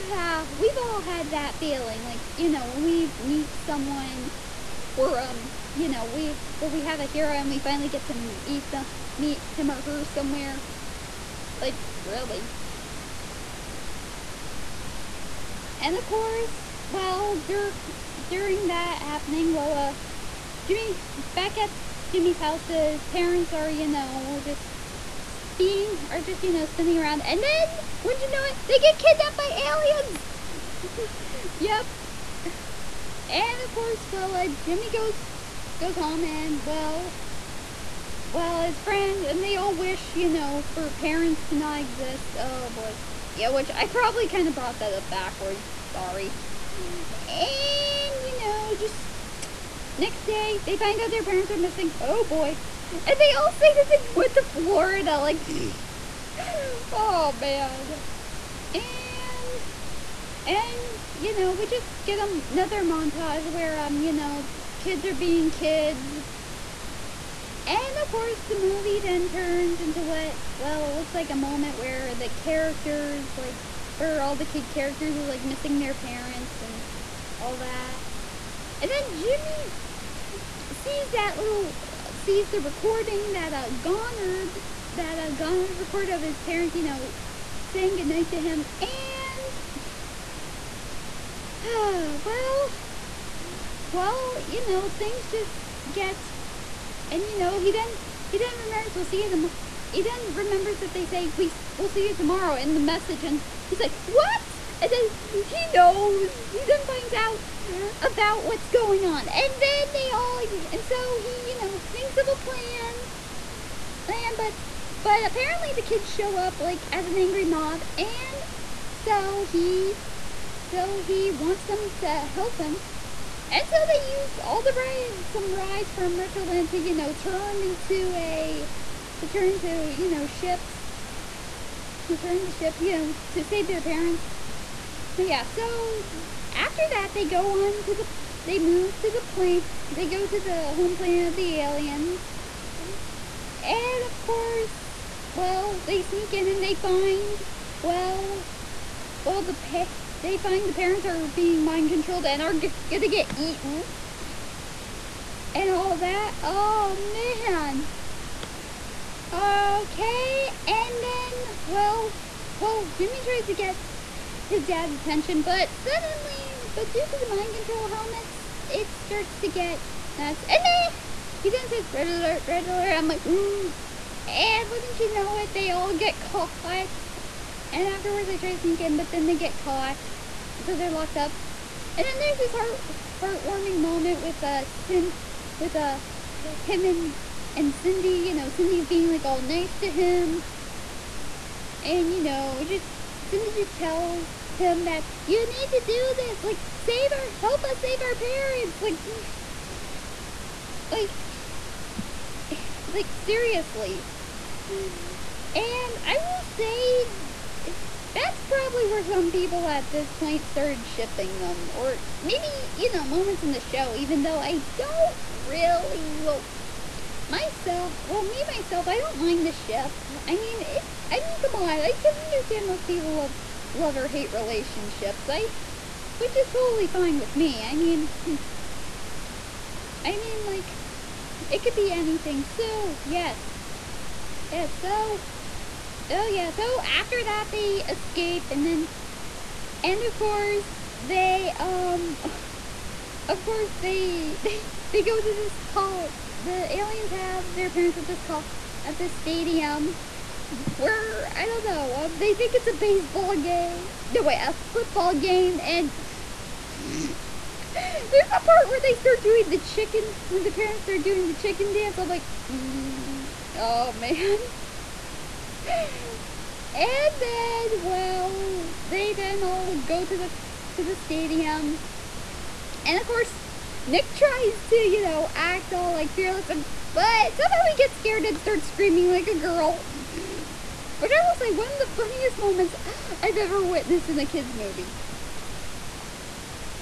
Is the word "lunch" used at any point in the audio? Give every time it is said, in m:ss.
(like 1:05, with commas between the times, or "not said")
not said.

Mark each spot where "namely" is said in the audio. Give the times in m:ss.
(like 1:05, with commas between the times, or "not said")
not said.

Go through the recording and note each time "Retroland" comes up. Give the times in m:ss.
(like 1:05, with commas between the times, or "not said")
2:06.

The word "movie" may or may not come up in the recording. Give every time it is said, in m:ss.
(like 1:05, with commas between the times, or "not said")
1:08, 4:44.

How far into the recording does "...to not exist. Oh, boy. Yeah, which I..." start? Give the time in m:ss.
0:41.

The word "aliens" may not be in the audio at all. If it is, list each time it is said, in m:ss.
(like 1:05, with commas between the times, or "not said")
0:29, 2:21, 4:06.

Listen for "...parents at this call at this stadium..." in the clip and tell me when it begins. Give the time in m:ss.
4:07.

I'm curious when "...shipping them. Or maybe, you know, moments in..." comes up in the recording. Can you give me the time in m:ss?
3:30.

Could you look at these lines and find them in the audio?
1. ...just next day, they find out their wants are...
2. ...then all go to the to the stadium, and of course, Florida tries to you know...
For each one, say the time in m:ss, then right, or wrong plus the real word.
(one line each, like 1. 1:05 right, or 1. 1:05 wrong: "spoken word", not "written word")
1. 0:48 wrong: "parents", not "wants"
2. 4:29 wrong: "Nick", not "Florida".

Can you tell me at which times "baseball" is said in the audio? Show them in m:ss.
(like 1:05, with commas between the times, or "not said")
4:12.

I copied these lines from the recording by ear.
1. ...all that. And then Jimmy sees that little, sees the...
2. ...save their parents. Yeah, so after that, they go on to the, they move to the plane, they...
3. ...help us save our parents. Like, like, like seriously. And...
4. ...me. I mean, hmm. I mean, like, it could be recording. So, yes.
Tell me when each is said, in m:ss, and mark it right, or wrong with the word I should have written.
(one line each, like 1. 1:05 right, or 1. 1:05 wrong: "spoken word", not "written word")
1. 1:17 right
2. 2:13 right
3. 3:17 right
4. 3:47 wrong: "anything", not "recording".